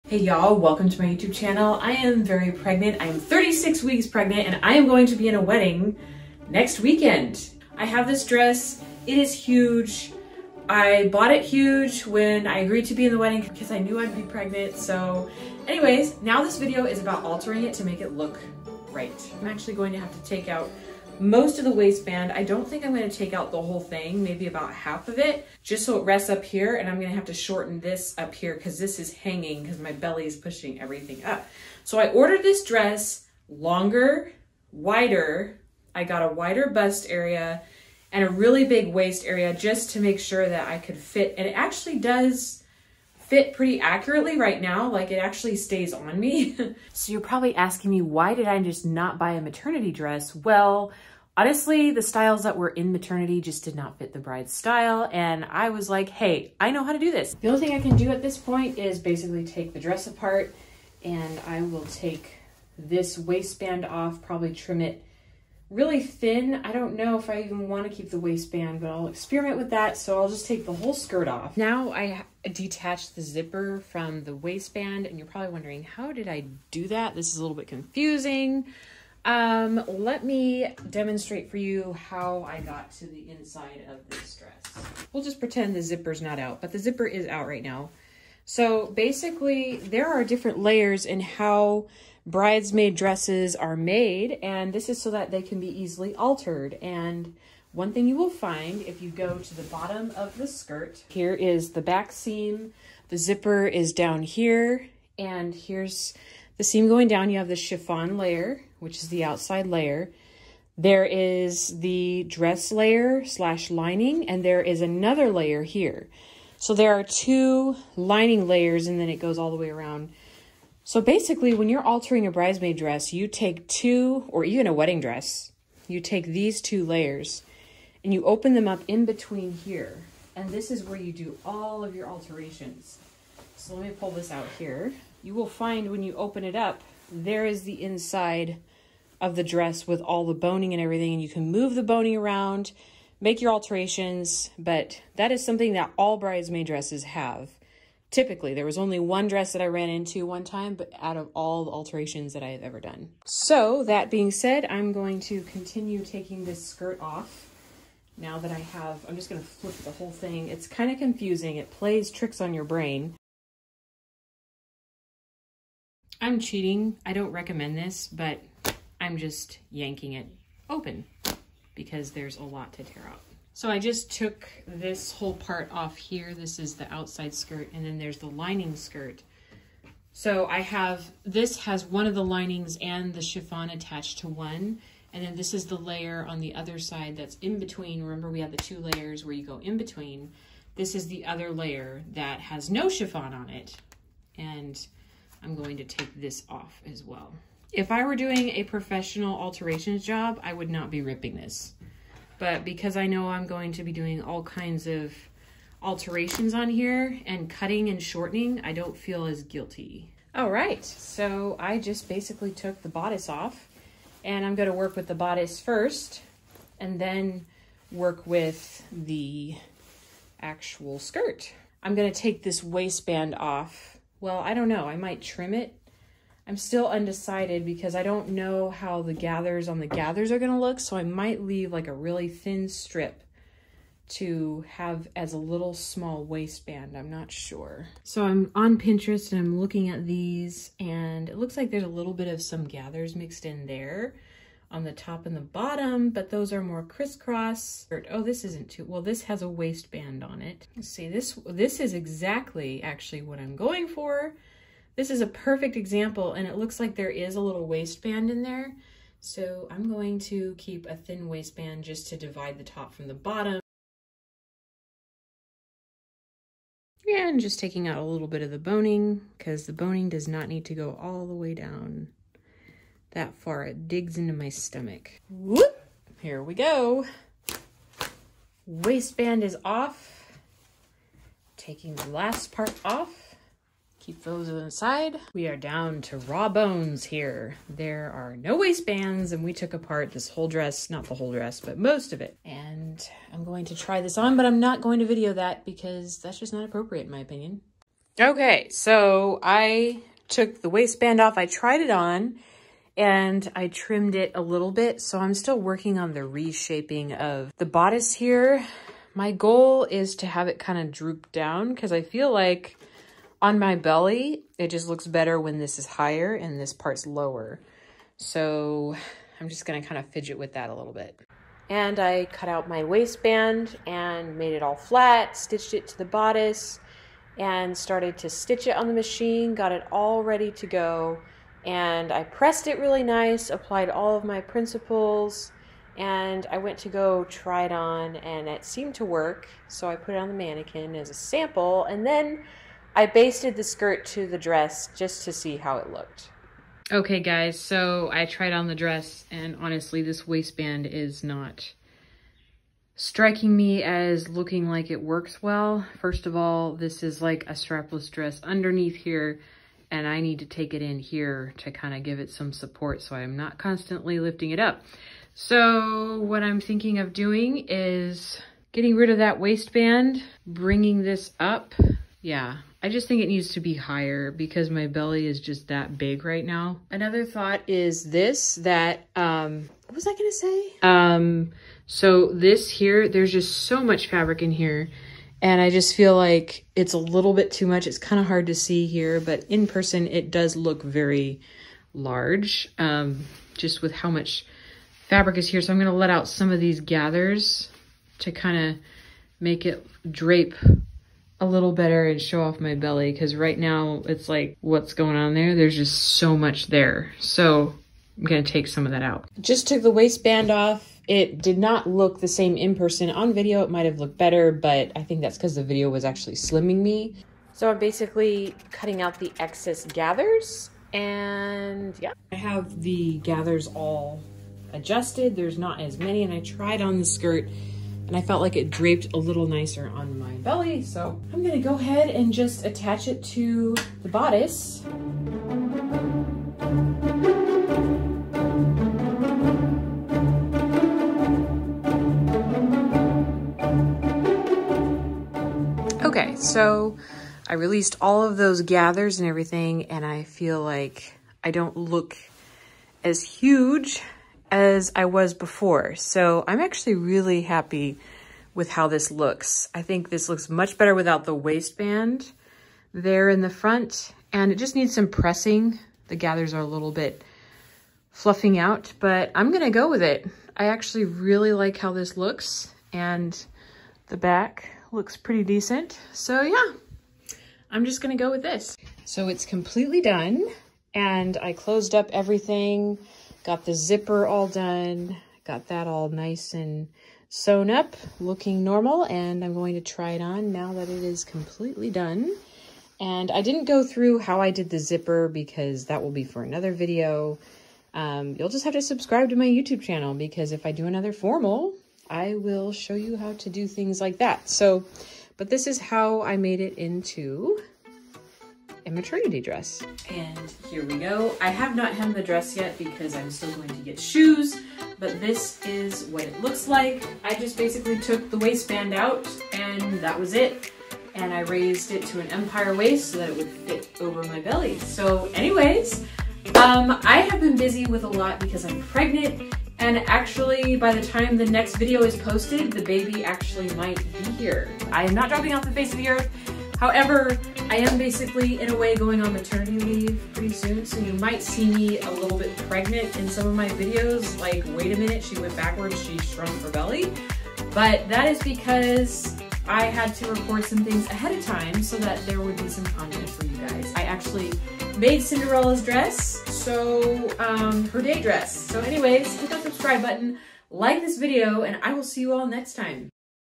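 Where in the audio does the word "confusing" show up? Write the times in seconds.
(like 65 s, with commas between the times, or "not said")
77 s, 160 s.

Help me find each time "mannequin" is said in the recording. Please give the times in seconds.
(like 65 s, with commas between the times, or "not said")
340 s.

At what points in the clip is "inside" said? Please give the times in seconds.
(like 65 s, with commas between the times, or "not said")
83 s, 137 s, 284 s.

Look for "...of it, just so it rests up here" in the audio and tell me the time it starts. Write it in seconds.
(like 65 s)
25 s.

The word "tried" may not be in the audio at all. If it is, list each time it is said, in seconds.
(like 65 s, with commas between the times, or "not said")
301 s, 348 s, 426 s.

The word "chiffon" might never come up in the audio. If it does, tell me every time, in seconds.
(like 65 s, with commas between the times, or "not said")
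107 s, 183 s, 192 s.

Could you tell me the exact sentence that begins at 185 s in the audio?
And then this is the layer on the other side that's in between.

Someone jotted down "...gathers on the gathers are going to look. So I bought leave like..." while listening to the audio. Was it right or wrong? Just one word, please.
wrong.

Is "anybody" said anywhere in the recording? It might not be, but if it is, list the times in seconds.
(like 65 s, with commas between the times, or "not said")
not said.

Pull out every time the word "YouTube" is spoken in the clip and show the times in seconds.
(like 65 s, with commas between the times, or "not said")
1 s, 499 s.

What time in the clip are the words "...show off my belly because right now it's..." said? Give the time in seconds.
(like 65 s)
402 s.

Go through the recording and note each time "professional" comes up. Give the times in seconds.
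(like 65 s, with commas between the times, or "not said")
198 s.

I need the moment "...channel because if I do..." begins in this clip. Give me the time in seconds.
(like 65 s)
499 s.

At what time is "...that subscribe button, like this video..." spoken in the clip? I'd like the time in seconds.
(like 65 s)
559 s.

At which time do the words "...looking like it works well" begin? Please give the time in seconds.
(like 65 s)
354 s.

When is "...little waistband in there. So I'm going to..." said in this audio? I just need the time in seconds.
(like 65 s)
257 s.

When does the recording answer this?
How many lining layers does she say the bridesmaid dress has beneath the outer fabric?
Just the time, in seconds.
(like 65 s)
117 s.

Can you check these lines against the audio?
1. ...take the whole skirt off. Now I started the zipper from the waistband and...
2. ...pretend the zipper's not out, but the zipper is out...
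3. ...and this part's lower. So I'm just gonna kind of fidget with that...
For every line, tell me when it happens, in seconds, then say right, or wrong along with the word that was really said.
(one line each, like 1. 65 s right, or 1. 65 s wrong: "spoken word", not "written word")
1. 70 s wrong: "detached", not "started"
2. 85 s right
3. 316 s right.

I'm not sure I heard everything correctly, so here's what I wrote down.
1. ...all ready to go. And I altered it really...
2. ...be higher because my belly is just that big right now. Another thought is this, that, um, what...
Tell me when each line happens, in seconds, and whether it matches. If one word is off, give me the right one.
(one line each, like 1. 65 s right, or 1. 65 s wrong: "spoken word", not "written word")
1. 329 s wrong: "pressed", not "altered"
2. 373 s right.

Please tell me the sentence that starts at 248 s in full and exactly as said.
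Oh, this isn't too, well, this has a waistband on it.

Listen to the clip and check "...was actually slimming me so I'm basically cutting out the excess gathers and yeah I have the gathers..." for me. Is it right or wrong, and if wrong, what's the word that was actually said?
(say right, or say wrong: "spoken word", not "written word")
right.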